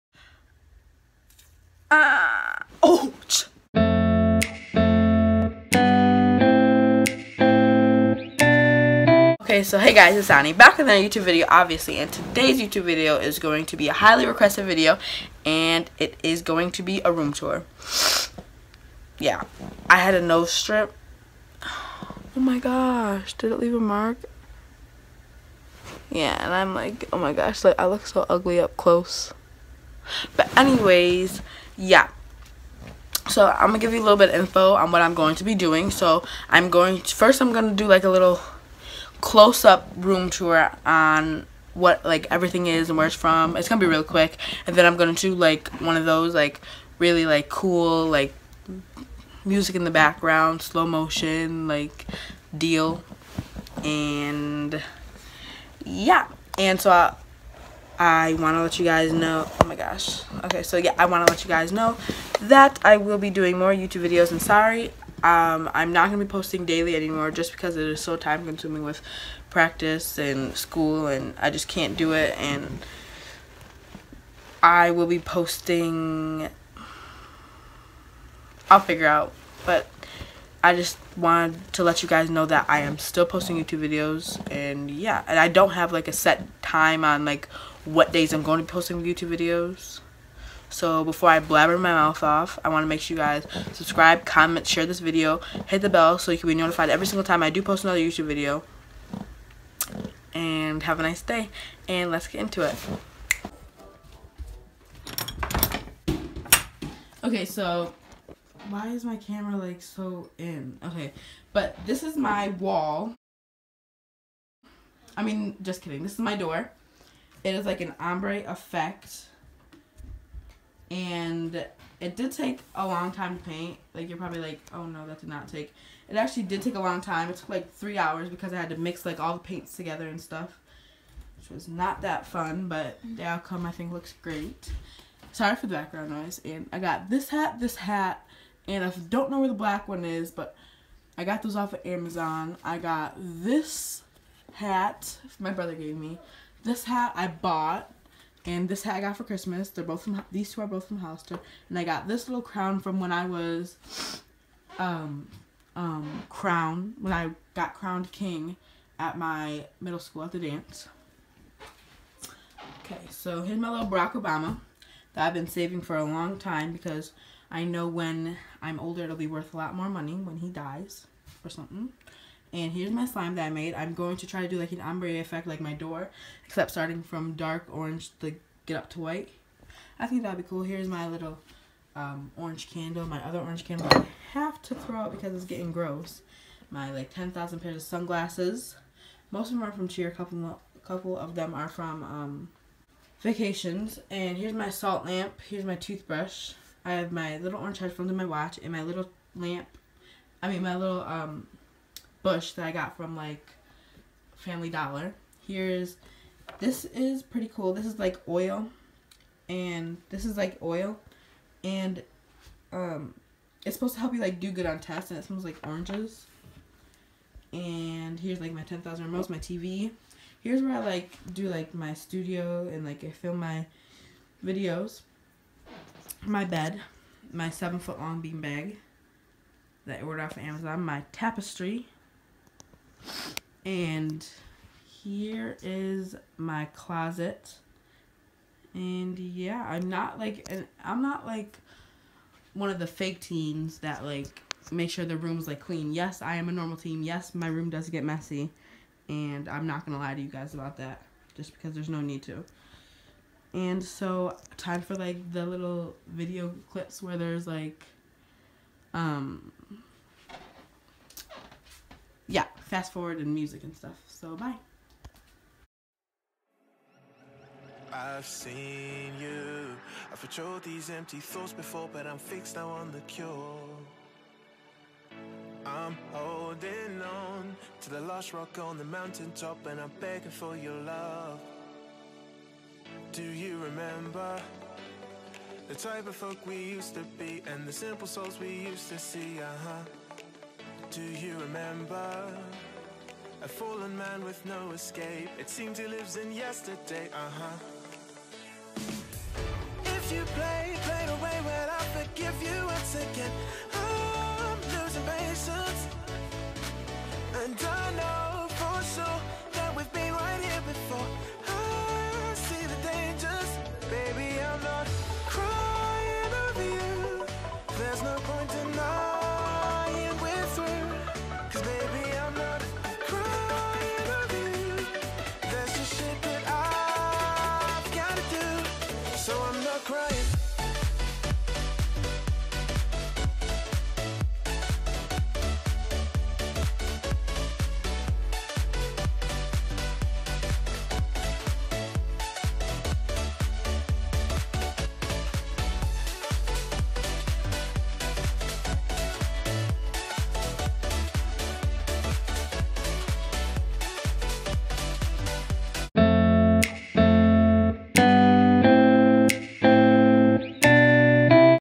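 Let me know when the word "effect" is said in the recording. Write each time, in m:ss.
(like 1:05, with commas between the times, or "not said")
1:58, 2:55.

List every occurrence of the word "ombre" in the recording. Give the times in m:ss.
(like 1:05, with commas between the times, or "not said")
1:57, 2:54.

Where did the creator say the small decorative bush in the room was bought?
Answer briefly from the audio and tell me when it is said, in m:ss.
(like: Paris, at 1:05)
Family Dollar, at 3:24.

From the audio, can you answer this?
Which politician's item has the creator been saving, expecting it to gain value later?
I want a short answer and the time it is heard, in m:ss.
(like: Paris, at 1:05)
Barack Obama, at 2:43.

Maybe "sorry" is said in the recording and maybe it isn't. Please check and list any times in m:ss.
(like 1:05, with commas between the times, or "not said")
1:04, 2:15.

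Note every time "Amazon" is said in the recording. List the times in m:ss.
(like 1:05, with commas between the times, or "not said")
2:21, 3:50.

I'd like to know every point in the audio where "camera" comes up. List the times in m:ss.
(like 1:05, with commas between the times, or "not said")
1:49.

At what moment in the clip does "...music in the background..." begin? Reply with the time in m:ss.
0:49.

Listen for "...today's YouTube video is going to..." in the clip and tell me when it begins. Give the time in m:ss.
0:12.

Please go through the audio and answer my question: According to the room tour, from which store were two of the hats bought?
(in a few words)
Hollister.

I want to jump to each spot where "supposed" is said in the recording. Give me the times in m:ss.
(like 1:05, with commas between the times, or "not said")
3:33.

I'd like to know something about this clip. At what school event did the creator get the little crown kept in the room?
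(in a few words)
the dance.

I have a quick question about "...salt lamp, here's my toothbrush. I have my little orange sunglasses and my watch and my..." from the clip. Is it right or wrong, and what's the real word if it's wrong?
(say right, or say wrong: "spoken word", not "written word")
wrong: "headphones", not "sunglasses".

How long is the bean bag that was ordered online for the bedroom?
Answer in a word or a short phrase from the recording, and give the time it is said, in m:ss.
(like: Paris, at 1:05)
7 feet, at 3:47.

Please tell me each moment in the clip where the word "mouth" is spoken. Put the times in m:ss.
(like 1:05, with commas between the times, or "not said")
1:31.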